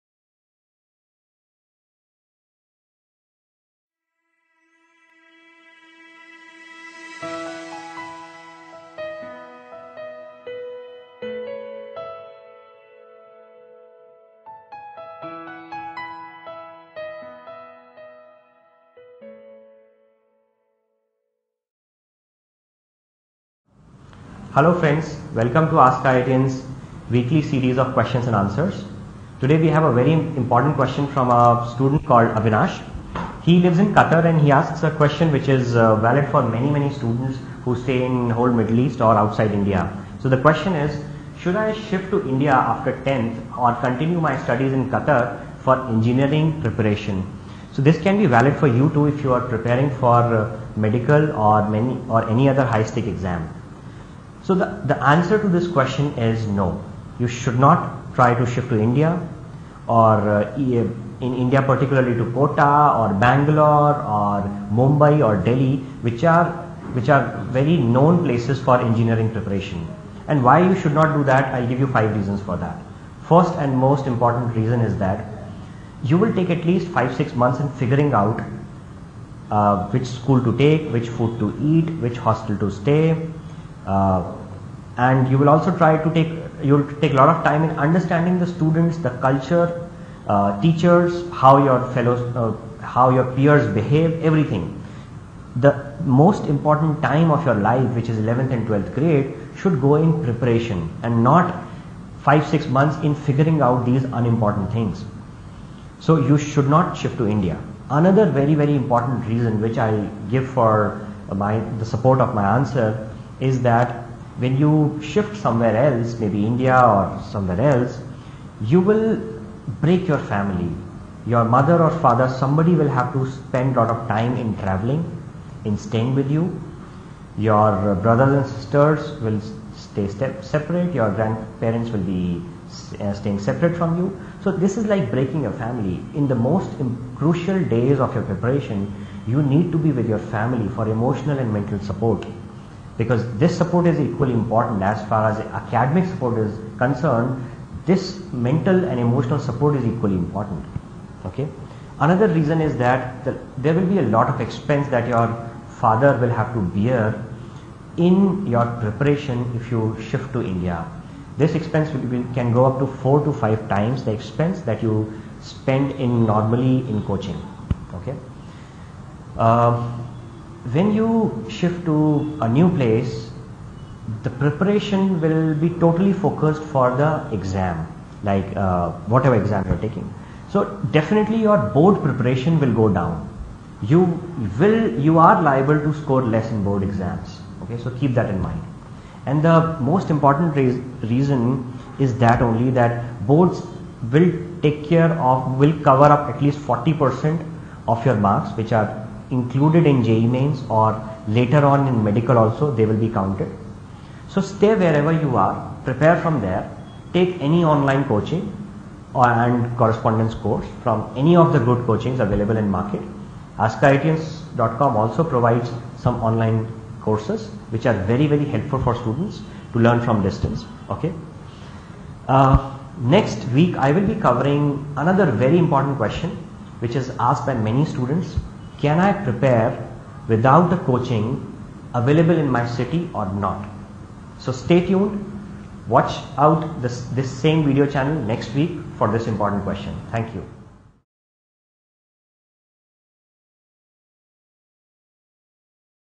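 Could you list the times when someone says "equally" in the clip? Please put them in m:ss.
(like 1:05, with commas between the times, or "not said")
2:23, 2:29.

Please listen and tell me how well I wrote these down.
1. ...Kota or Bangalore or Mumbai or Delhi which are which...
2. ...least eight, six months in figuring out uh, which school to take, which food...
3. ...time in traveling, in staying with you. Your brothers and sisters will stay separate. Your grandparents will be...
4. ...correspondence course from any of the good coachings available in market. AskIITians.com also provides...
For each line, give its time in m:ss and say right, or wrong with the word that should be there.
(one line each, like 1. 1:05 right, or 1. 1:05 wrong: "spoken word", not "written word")
1. 1:02 right
2. 1:16 wrong: "five", not "eight"
3. 2:04 right
4. 3:29 right.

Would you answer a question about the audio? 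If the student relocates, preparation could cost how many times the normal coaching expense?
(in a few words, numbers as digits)
4 to 5 times.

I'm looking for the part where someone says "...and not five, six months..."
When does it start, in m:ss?
1:41.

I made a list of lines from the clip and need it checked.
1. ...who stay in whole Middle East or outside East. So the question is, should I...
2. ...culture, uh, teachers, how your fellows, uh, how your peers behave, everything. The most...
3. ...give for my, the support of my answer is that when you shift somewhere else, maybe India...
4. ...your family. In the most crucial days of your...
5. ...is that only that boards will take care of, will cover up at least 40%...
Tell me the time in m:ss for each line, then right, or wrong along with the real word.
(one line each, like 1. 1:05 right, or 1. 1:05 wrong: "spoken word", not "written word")
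1. 0:37 wrong: "India", not "East"
2. 1:29 right
3. 1:50 right
4. 2:15 right
5. 3:11 right.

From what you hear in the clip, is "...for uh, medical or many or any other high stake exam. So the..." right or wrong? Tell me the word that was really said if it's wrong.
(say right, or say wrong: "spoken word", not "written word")
right.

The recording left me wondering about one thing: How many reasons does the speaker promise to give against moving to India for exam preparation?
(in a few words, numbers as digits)
5.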